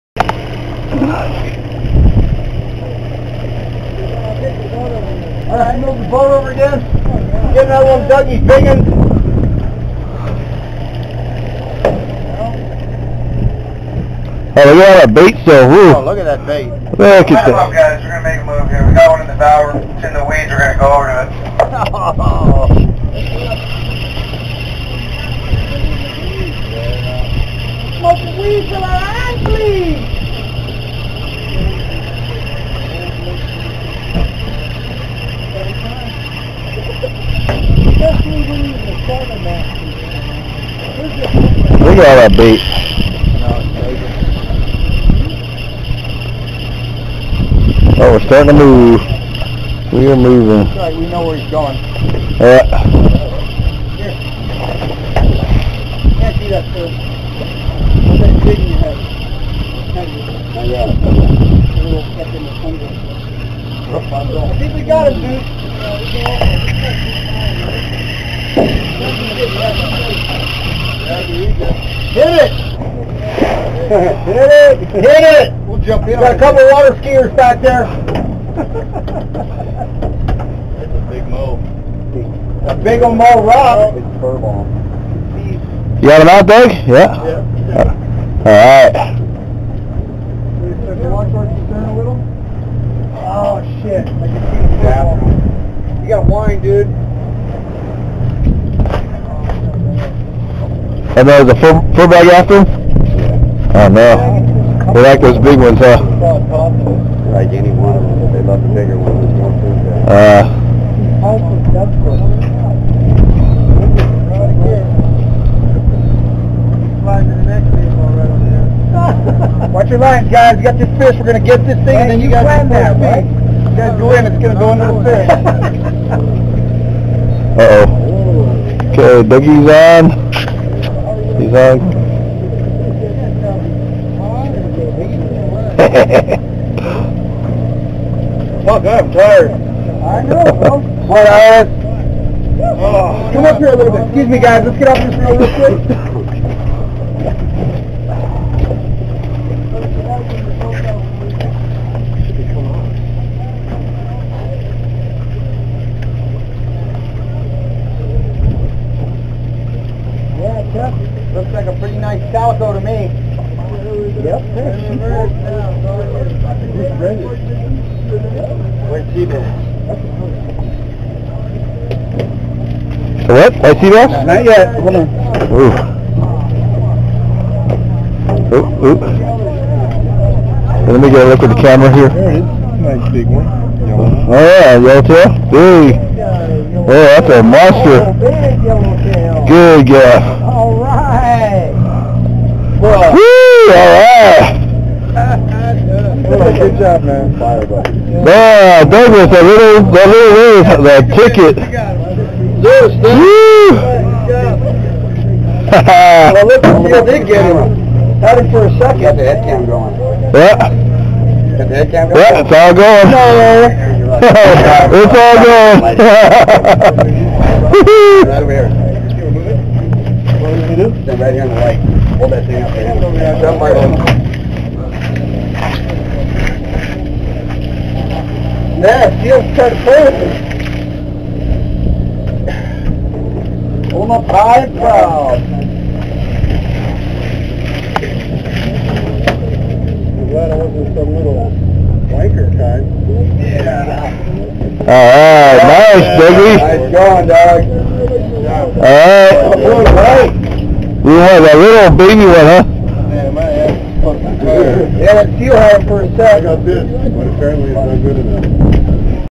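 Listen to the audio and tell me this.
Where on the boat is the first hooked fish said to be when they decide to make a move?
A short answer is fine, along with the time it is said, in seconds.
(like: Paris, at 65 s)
In the bow, at 19 s.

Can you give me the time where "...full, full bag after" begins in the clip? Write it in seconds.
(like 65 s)
101 s.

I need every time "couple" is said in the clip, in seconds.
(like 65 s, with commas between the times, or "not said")
76 s.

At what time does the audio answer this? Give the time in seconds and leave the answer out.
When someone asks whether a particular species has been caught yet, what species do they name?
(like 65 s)
173 s.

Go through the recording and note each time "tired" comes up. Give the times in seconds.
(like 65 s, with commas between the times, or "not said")
139 s, 254 s.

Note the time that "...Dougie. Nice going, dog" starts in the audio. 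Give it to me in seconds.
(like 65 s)
246 s.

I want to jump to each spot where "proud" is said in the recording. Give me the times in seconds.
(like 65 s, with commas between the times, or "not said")
234 s.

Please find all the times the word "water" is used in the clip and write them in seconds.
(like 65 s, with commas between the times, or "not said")
76 s.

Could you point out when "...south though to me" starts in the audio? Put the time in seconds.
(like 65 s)
162 s.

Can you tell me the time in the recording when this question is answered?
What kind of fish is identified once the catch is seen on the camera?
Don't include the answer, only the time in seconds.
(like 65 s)
184 s.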